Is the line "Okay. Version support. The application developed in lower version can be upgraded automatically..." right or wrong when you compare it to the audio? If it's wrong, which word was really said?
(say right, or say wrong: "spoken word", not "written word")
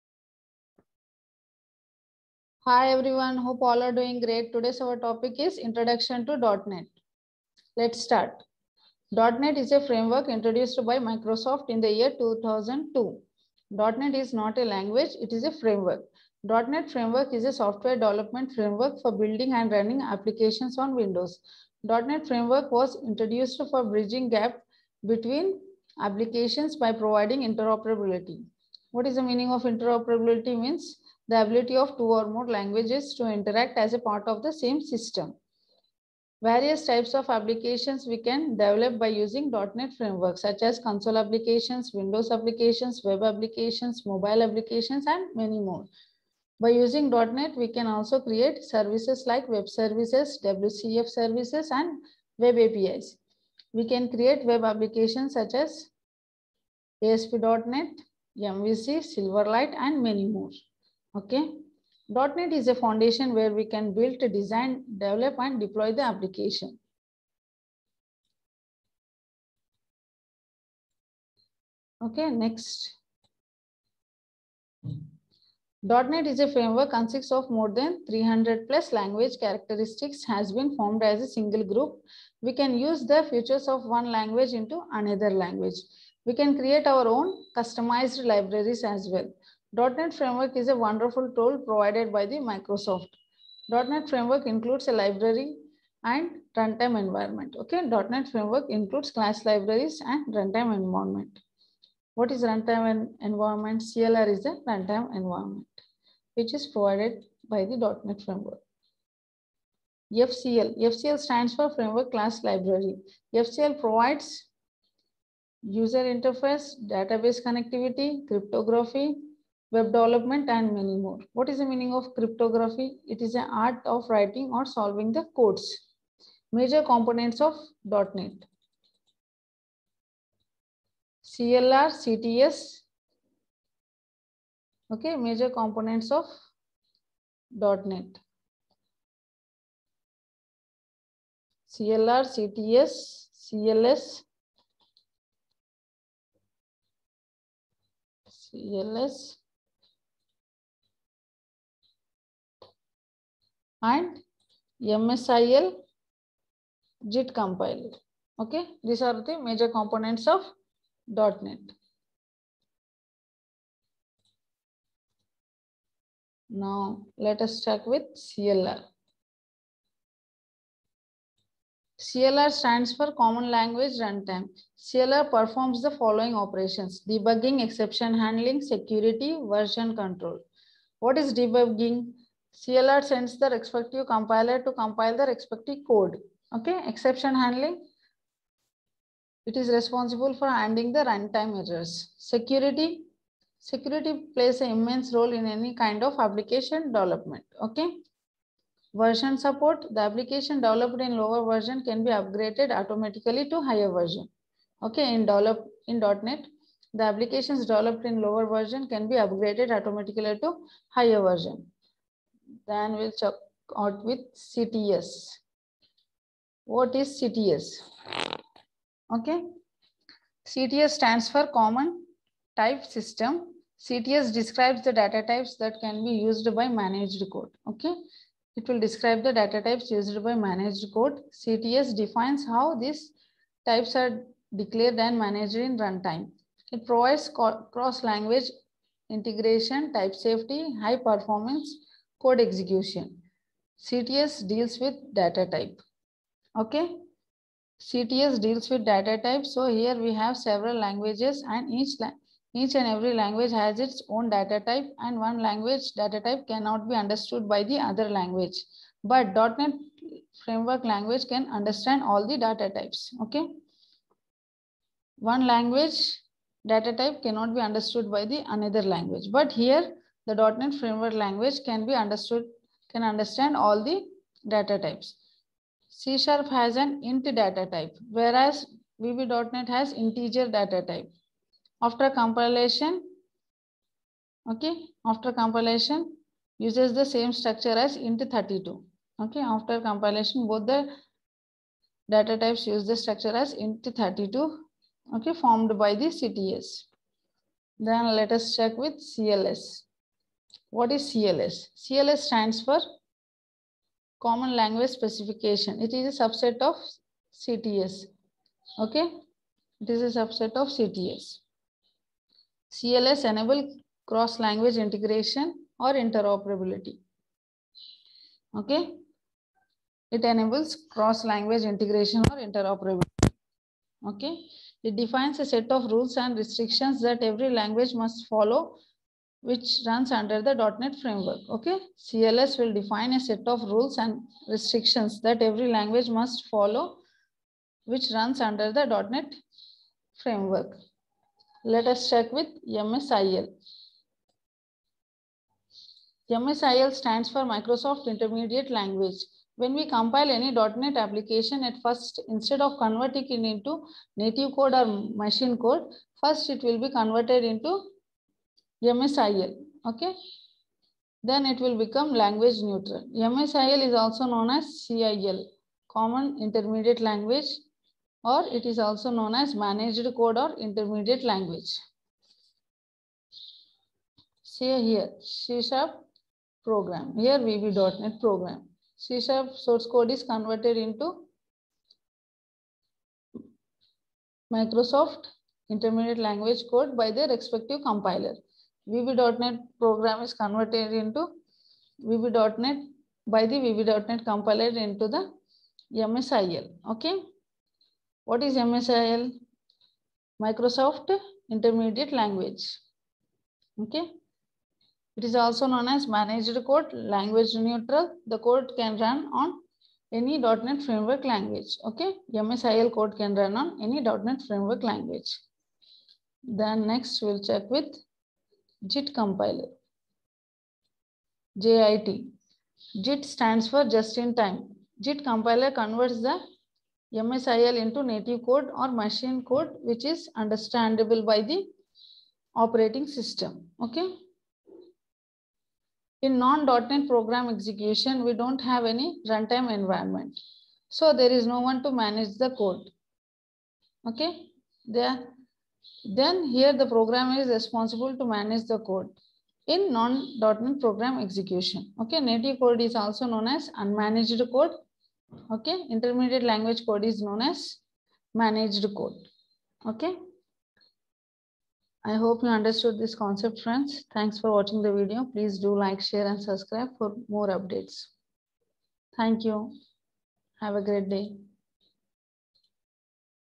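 right.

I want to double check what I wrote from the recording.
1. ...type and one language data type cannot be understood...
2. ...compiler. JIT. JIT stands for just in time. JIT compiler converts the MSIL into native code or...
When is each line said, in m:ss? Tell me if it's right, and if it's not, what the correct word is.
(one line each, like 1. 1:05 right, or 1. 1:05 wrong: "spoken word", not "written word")
1. 4:14 right
2. 6:59 right.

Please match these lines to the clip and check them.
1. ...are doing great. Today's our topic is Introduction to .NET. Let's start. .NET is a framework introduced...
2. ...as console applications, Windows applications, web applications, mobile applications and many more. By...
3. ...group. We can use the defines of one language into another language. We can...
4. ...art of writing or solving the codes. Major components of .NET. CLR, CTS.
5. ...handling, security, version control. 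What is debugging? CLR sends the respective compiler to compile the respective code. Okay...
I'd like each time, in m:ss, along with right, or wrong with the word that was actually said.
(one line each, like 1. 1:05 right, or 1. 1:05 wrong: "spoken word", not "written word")
1. 0:03 right
2. 0:40 right
3. 1:21 wrong: "features", not "defines"
4. 2:03 right
5. 2:58 right.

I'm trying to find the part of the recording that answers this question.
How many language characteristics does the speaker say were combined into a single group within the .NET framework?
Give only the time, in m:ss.
1:18.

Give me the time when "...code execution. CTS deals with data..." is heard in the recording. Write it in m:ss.
4:02.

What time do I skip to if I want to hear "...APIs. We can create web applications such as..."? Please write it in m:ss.
0:52.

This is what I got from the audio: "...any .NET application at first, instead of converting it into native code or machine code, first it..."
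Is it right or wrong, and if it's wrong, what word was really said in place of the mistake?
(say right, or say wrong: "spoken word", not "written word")
right.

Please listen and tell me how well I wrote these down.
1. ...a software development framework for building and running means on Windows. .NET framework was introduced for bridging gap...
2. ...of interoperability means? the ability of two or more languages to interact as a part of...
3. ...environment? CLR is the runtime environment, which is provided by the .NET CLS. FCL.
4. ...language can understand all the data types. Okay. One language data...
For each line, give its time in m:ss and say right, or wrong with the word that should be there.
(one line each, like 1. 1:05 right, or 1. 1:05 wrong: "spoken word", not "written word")
1. 0:17 wrong: "applications", not "means"
2. 0:29 right
3. 1:43 wrong: "Framework", not "CLS"
4. 4:20 right.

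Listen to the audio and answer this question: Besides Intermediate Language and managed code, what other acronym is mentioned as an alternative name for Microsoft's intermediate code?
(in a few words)
CIL.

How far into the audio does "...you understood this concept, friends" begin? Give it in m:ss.
7:42.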